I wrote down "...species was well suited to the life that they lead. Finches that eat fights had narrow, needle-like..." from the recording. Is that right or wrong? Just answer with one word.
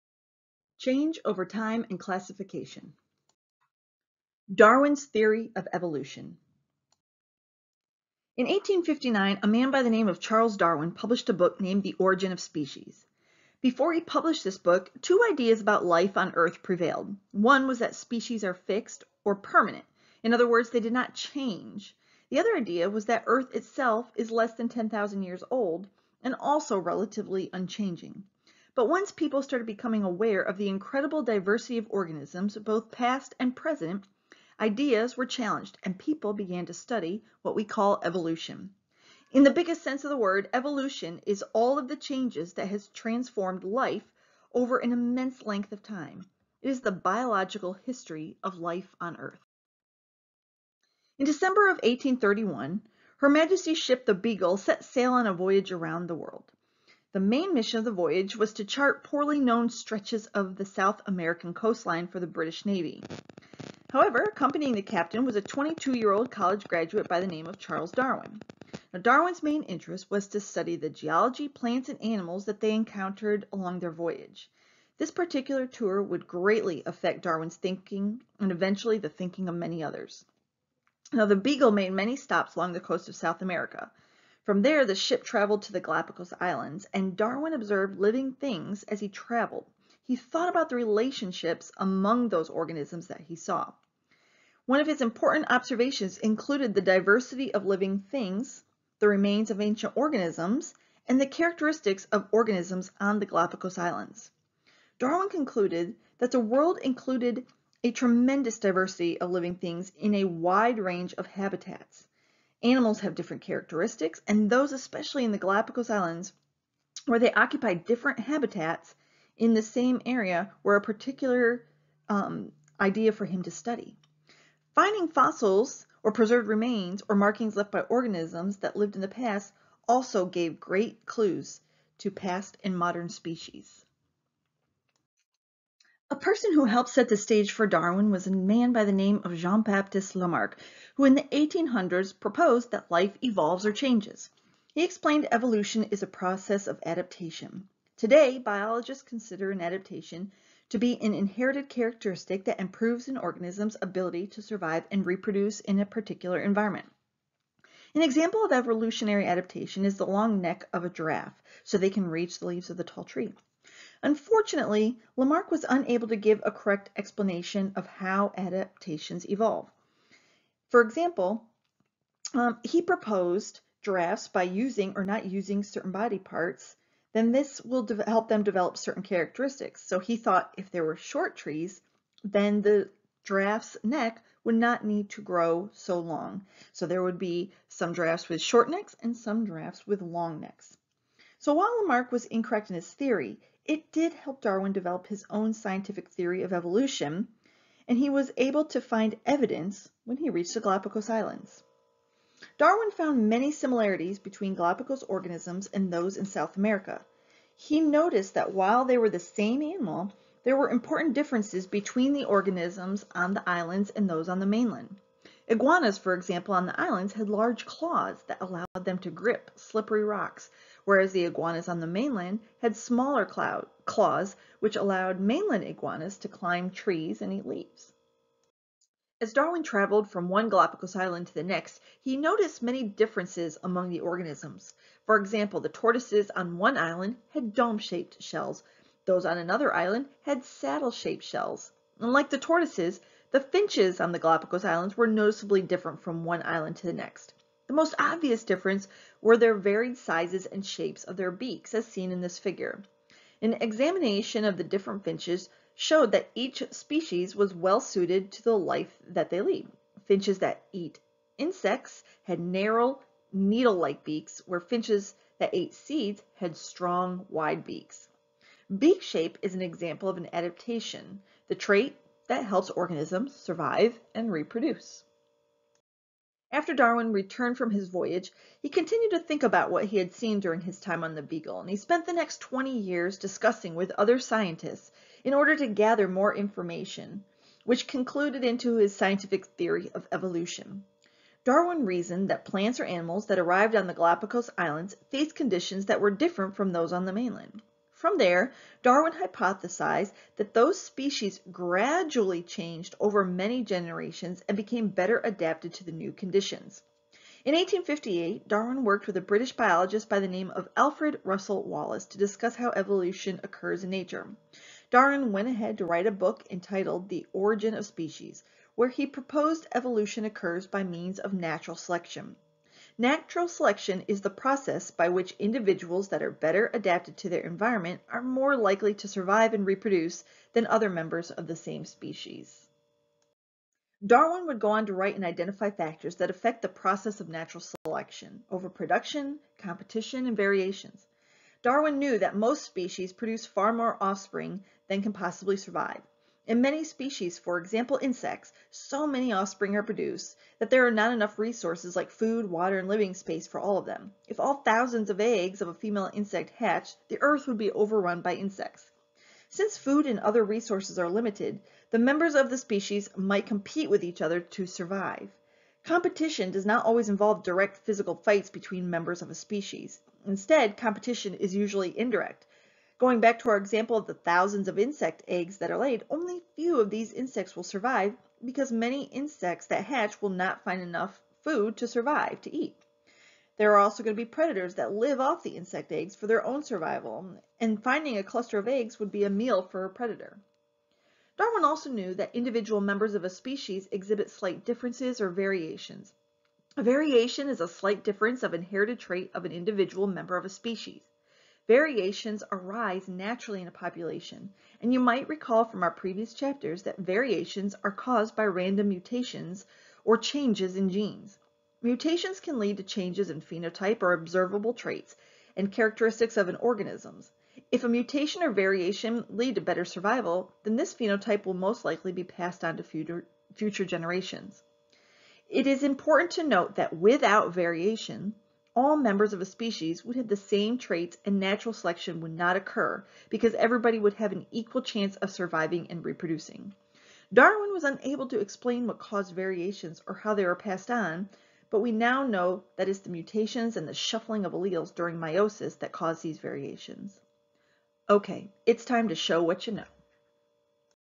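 wrong.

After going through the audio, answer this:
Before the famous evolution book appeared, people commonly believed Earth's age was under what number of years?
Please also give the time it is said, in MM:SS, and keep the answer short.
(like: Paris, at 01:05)
10,000, at 00:24.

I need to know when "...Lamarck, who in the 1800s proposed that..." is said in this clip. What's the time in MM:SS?
02:20.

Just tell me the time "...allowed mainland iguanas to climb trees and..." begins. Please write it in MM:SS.
03:44.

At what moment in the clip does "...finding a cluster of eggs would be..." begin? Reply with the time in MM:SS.
06:27.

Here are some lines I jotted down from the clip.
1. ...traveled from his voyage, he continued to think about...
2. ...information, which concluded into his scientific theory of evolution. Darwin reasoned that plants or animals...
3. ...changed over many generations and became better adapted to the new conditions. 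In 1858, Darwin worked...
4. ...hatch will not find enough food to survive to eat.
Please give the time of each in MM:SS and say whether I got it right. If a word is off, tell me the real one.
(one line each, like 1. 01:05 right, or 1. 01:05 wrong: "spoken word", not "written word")
1. 04:37 wrong: "returned", not "traveled"
2. 04:46 right
3. 05:02 right
4. 06:19 right.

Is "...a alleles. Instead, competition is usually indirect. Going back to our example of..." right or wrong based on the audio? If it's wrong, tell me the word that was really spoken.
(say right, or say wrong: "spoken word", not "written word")
wrong: "species", not "alleles".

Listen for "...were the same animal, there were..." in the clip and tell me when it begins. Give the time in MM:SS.
03:28.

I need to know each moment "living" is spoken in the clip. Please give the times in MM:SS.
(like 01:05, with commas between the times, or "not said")
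01:28, 01:37, 01:49, 05:52.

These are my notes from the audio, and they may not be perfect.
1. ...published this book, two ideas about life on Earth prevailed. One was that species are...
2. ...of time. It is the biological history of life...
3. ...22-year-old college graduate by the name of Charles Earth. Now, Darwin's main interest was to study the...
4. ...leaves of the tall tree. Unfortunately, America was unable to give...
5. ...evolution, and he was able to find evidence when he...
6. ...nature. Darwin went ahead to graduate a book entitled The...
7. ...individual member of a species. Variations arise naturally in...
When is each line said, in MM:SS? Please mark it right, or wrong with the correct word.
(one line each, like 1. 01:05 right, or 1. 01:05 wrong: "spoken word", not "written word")
1. 00:14 right
2. 00:45 right
3. 01:05 wrong: "Darwin", not "Earth"
4. 02:42 wrong: "Lamarck", not "America"
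5. 03:16 right
6. 05:13 wrong: "write", not "graduate"
7. 06:39 right.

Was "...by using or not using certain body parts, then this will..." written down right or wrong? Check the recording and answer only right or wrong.
right.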